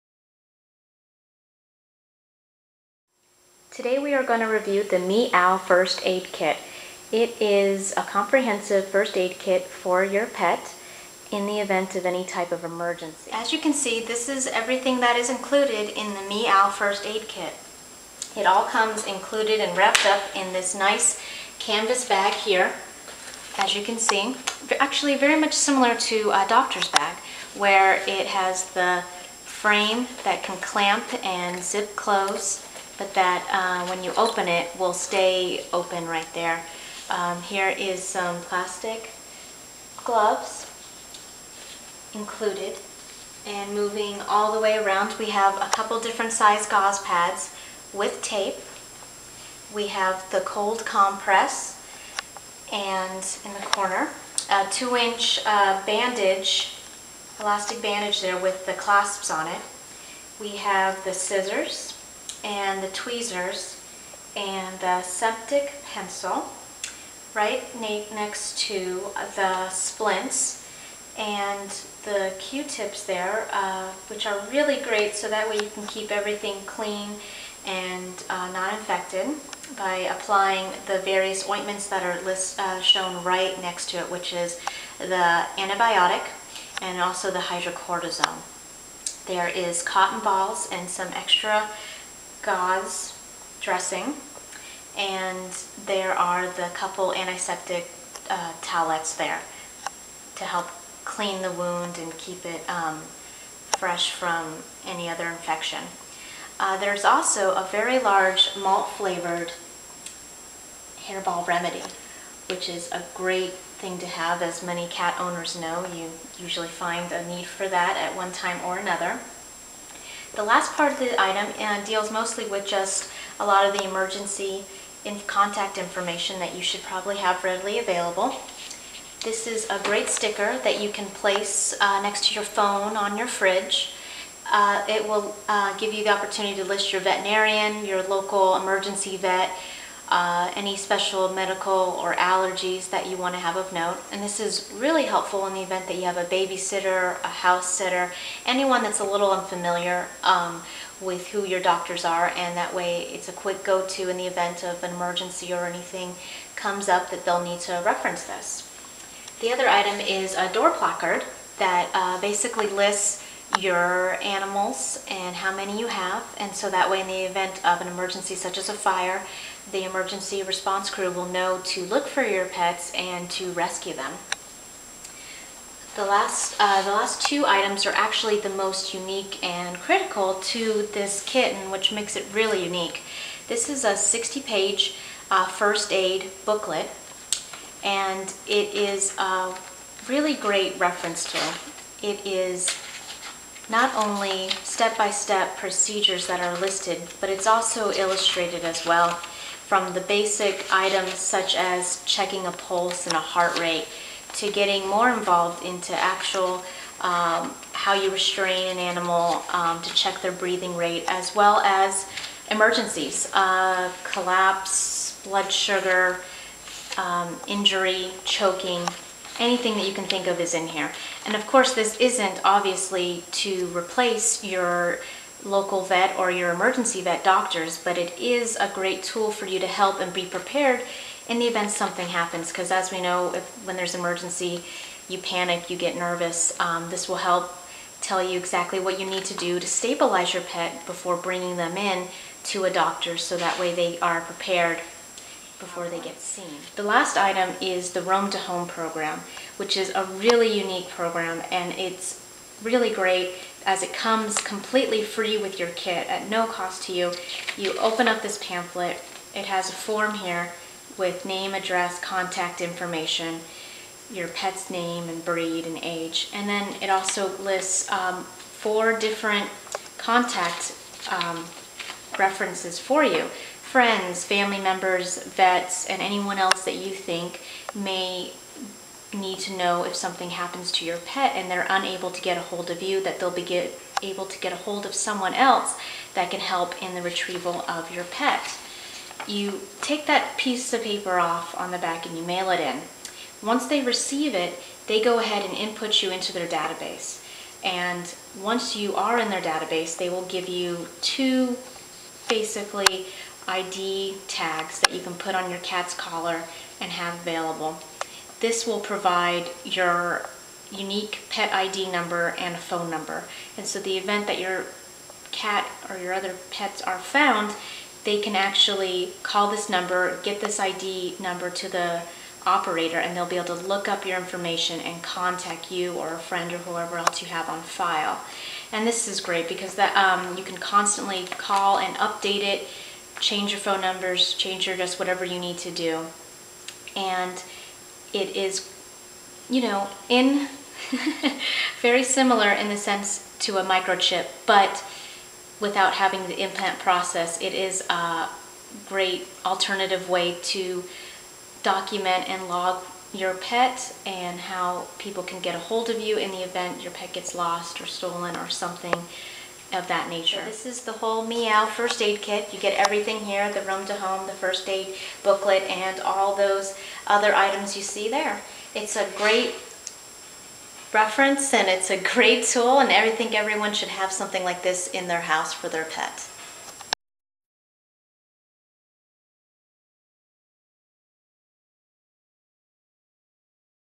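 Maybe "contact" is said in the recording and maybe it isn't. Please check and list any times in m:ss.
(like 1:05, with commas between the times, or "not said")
2:05, 4:22, 4:29, 5:25.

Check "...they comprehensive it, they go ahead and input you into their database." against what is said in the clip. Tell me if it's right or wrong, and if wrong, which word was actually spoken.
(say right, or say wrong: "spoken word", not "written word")
wrong: "receive", not "comprehensive".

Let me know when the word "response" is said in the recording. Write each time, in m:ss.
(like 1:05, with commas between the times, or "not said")
2:50.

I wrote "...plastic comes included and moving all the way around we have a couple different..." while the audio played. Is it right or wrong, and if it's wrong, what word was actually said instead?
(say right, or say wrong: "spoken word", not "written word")
wrong: "gloves", not "comes".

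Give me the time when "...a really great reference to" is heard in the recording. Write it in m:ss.
3:09.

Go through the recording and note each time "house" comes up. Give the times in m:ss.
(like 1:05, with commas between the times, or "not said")
2:27, 6:15.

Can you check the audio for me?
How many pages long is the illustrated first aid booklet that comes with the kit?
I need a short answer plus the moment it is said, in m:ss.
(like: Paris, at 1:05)
60, at 3:03.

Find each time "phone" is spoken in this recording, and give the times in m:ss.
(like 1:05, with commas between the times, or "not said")
2:12, 5:12, 5:33.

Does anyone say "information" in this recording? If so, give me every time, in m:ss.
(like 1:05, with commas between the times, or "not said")
2:05, 4:22, 5:24.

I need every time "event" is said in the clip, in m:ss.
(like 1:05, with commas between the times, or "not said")
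0:11, 2:25, 2:34, 2:47, 3:51, 5:13, 5:56.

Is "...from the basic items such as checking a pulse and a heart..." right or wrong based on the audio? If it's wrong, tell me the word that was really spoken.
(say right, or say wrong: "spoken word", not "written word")
right.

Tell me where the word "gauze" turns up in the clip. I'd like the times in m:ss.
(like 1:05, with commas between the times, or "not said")
0:46, 1:32.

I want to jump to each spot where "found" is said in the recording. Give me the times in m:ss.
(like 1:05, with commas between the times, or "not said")
5:16.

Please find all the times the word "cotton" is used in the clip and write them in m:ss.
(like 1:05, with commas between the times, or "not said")
1:29.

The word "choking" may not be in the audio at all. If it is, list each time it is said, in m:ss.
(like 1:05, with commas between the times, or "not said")
3:38.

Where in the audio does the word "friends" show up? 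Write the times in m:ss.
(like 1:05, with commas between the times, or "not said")
4:33, 5:26.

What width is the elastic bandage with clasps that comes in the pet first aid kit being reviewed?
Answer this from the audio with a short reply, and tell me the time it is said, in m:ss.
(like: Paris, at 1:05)
2 inch, at 0:54.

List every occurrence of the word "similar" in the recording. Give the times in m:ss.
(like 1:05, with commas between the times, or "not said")
0:25, 5:42.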